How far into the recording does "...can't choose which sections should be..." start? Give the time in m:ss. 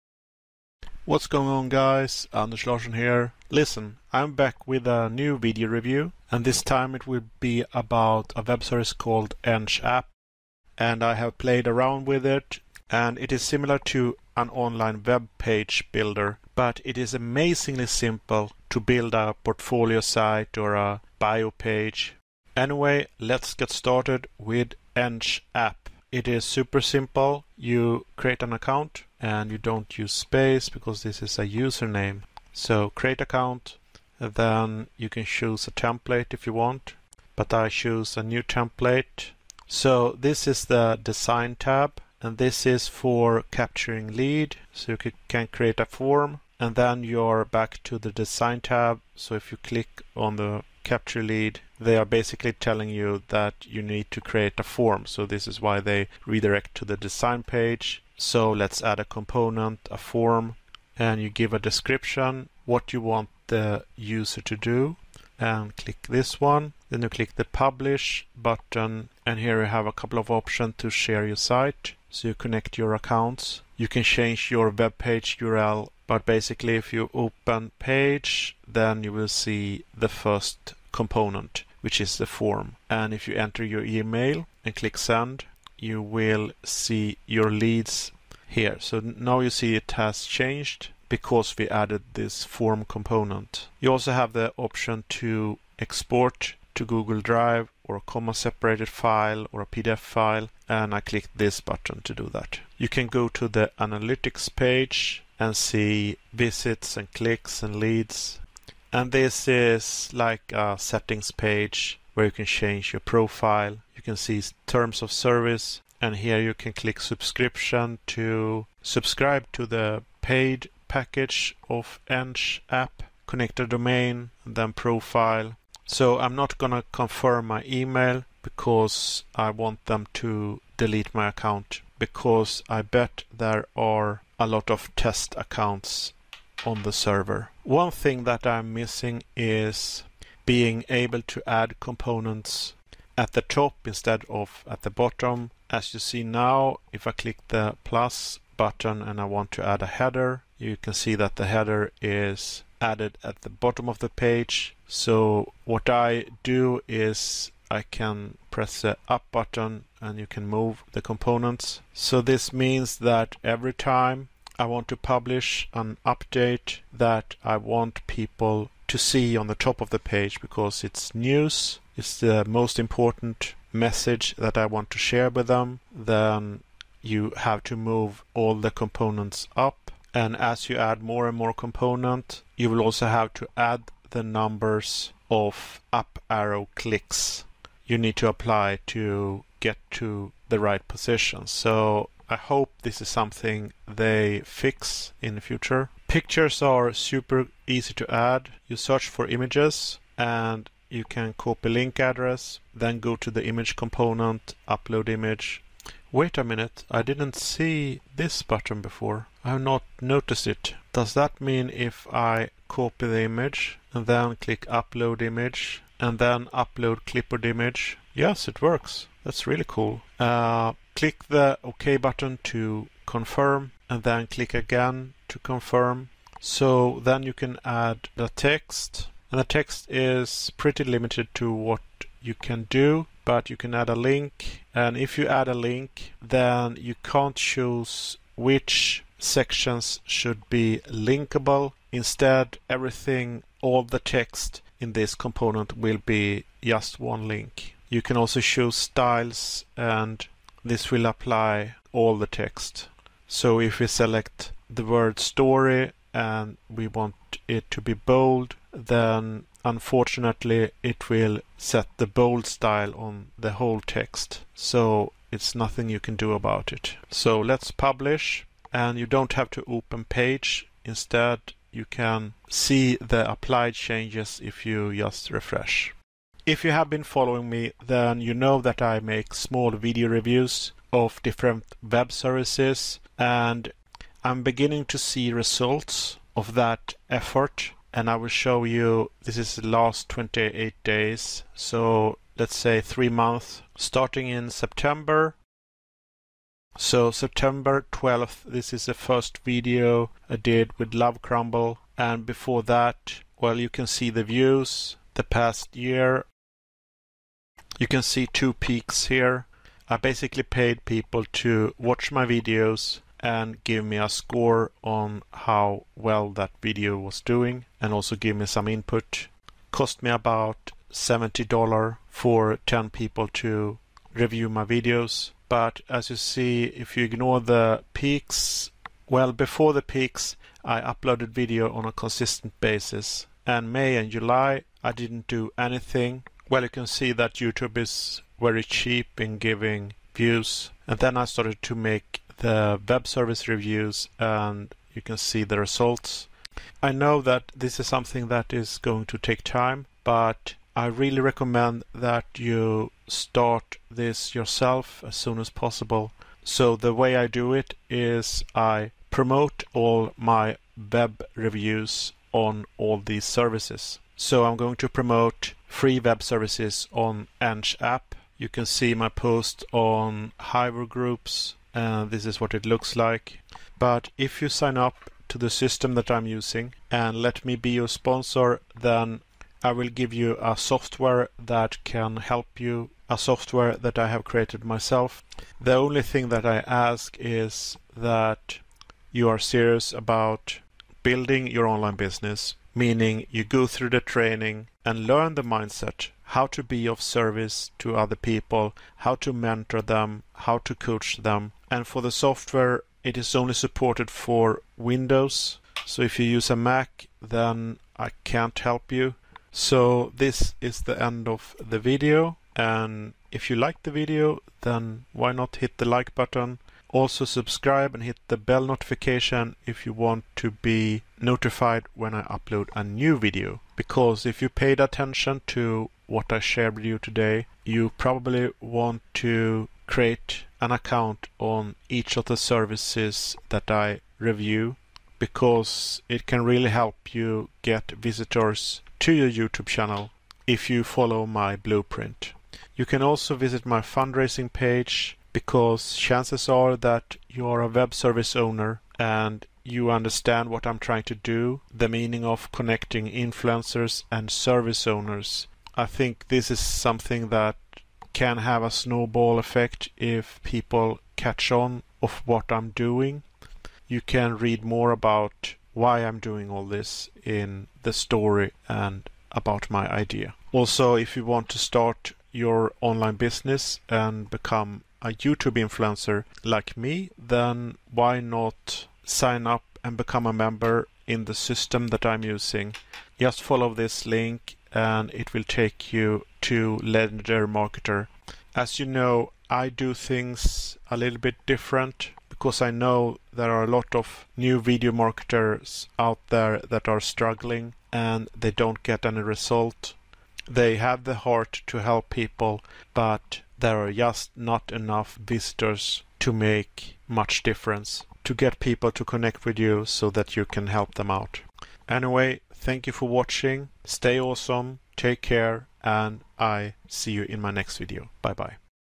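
3:57.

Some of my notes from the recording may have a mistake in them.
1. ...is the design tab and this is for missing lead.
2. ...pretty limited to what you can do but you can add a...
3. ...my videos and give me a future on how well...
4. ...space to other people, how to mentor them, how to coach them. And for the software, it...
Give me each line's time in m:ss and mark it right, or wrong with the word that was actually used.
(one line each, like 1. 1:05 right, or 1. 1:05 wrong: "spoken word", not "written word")
1. 0:40 wrong: "capturing", not "missing"
2. 3:50 right
3. 5:12 wrong: "score", not "future"
4. 6:37 wrong: "service", not "space".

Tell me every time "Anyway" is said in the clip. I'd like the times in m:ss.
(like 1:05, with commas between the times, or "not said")
0:22, 8:31.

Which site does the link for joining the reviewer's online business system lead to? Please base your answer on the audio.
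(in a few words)
Legendary Marketer.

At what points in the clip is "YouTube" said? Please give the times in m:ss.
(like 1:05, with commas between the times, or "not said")
5:37, 7:19, 7:55.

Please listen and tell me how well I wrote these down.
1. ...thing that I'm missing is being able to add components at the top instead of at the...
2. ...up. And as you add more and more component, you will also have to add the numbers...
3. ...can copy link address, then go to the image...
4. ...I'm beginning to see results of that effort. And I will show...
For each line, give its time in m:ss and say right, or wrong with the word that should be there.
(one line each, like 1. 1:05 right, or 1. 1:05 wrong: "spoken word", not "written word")
1. 2:17 right
2. 2:59 right
3. 3:21 right
4. 4:44 right.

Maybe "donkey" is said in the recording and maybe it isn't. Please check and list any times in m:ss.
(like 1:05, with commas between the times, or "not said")
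not said.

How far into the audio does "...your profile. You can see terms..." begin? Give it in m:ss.
1:52.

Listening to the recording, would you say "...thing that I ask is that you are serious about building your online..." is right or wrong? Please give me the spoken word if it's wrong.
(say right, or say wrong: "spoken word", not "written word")
right.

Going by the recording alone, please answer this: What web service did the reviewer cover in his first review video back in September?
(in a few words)
Love Crumble.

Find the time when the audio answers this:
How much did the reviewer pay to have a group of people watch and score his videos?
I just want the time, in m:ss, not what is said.
5:20.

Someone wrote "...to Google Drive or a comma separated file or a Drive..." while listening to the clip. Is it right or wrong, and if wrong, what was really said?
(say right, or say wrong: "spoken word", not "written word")
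wrong: "PDF", not "Drive".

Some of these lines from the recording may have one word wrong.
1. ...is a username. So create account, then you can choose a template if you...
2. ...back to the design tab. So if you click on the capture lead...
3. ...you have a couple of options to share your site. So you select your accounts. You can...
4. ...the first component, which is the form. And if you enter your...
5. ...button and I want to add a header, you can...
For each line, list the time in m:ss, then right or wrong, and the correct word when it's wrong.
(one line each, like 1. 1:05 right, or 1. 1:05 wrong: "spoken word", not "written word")
1. 0:31 right
2. 0:47 right
3. 1:09 wrong: "connect", not "select"
4. 1:19 right
5. 2:28 right.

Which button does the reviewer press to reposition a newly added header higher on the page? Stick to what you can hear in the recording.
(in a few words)
the up button.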